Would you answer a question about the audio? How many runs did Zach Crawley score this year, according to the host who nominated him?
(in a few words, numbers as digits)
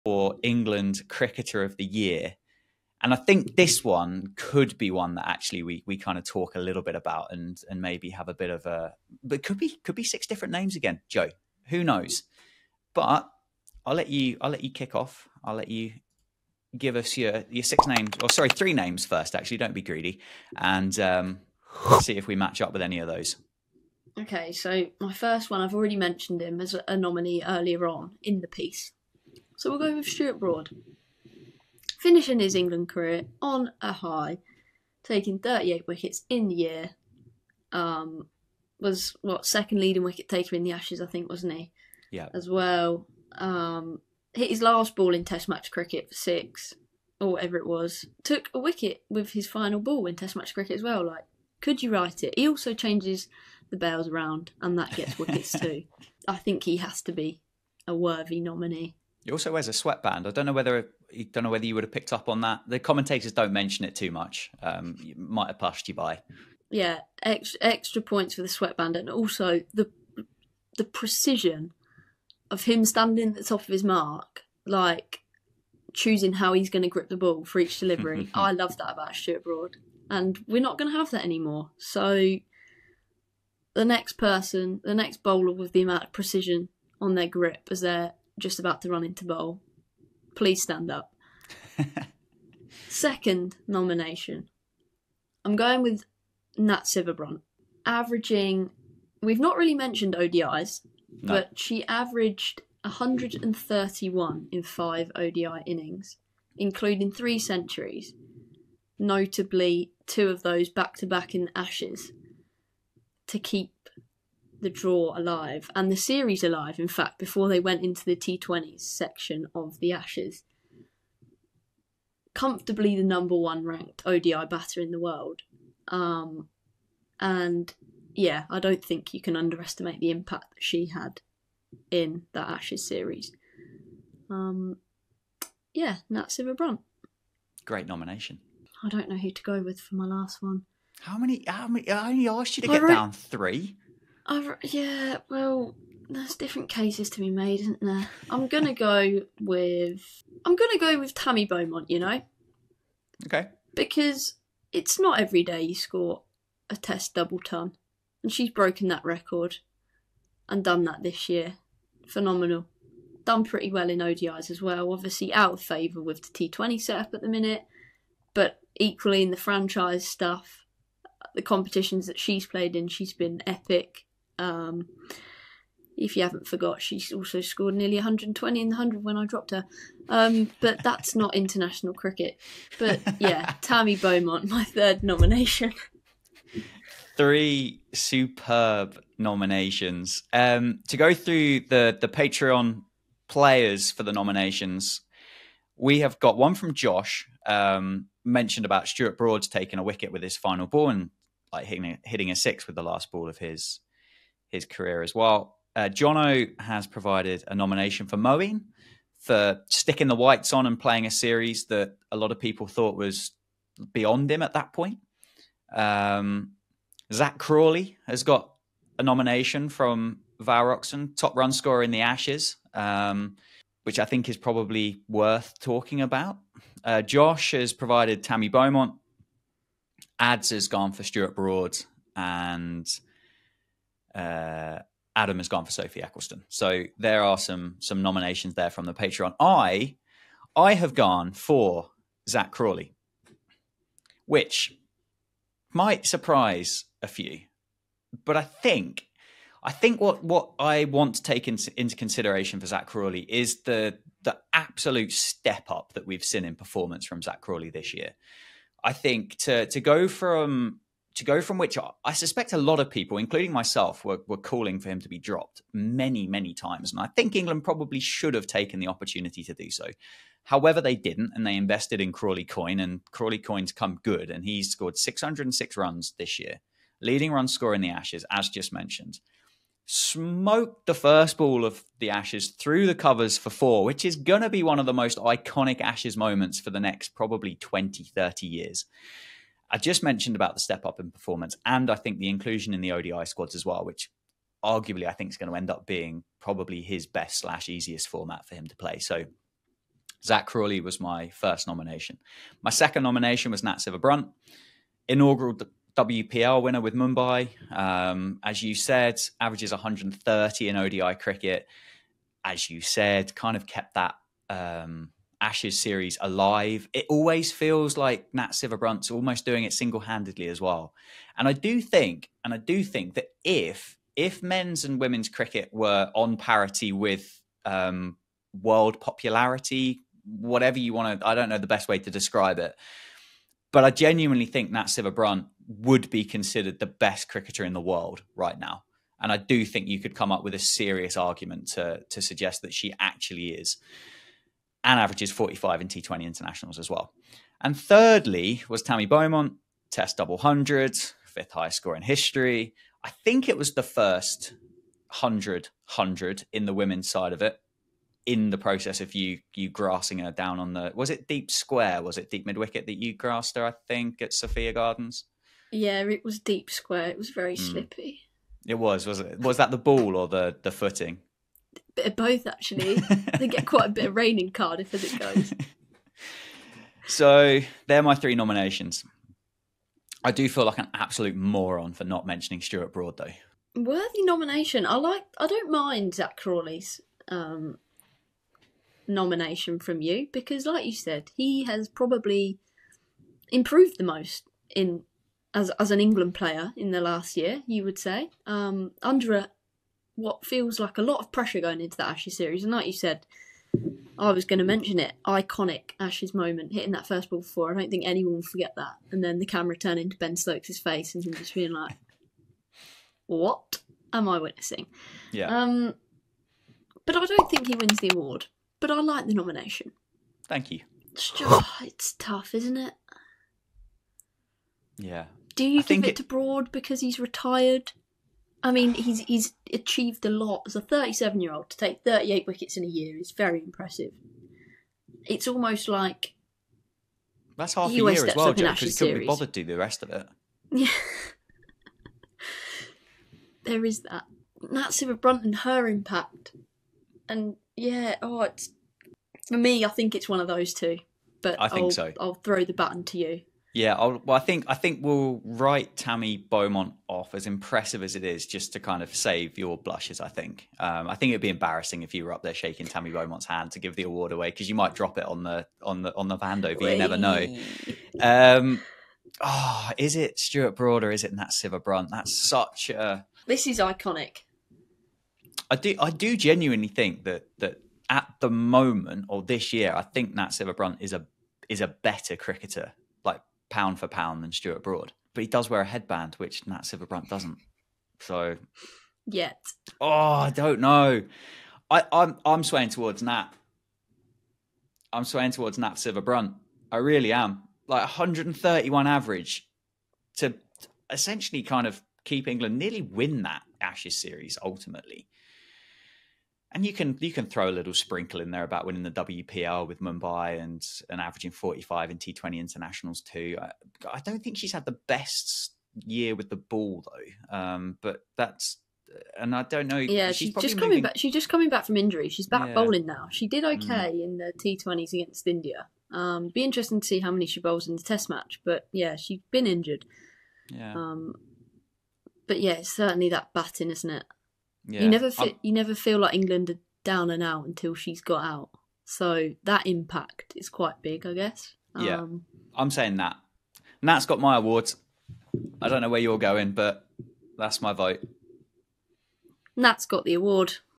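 606.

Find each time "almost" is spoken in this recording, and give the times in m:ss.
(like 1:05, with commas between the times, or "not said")
5:19, 7:15.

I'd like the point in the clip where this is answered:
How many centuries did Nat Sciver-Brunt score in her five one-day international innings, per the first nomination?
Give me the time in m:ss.
1:47.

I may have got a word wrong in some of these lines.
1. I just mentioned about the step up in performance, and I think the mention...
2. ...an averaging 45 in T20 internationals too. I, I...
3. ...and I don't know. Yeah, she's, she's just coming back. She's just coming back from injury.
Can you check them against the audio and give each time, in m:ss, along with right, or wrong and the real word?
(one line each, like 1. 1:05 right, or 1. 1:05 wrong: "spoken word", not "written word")
1. 4:49 wrong: "inclusion", not "mention"
2. 8:31 right
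3. 8:39 right.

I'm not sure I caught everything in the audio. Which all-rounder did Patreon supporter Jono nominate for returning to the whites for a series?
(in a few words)
Moeen.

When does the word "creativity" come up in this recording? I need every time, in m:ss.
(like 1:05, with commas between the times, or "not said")
not said.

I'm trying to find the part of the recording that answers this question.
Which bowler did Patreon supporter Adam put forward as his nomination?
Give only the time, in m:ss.
3:55.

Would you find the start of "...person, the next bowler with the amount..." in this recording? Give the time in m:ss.
1:24.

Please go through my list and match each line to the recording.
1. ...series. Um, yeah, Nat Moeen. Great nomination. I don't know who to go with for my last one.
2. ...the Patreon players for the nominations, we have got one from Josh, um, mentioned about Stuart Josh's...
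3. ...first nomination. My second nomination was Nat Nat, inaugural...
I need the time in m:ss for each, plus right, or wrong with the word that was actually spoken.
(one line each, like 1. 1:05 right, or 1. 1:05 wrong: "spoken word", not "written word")
1. 2:12 wrong: "Brunt", not "Moeen"
2. 3:12 wrong: "Broad", not "Josh"
3. 5:01 wrong: "Brunt", not "Nat".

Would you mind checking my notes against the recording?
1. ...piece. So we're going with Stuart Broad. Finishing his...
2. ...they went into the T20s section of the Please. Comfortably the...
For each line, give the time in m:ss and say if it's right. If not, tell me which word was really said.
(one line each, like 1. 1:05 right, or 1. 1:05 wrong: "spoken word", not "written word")
1. 0:28 right
2. 1:57 wrong: "Ashes", not "Please".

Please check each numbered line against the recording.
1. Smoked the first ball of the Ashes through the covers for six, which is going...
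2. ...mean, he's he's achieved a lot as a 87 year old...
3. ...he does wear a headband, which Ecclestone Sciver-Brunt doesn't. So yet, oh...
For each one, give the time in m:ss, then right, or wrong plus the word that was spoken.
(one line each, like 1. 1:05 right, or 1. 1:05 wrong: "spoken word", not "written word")
1. 4:39 wrong: "four", not "six"
2. 7:08 wrong: "37", not "87"
3. 8:05 wrong: "Nat", not "Ecclestone".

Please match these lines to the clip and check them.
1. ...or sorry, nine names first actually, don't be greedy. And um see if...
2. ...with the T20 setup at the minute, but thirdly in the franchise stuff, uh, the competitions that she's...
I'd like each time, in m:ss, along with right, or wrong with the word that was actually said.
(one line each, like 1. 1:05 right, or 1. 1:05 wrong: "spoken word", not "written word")
1. 0:18 wrong: "three", not "nine"
2. 2:46 wrong: "equally", not "thirdly".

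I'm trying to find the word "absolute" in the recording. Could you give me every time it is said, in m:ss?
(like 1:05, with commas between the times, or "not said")
4:14, 6:20.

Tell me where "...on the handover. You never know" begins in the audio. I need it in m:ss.
7:46.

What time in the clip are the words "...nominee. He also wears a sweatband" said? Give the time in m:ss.
0:58.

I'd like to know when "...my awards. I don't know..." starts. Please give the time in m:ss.
9:04.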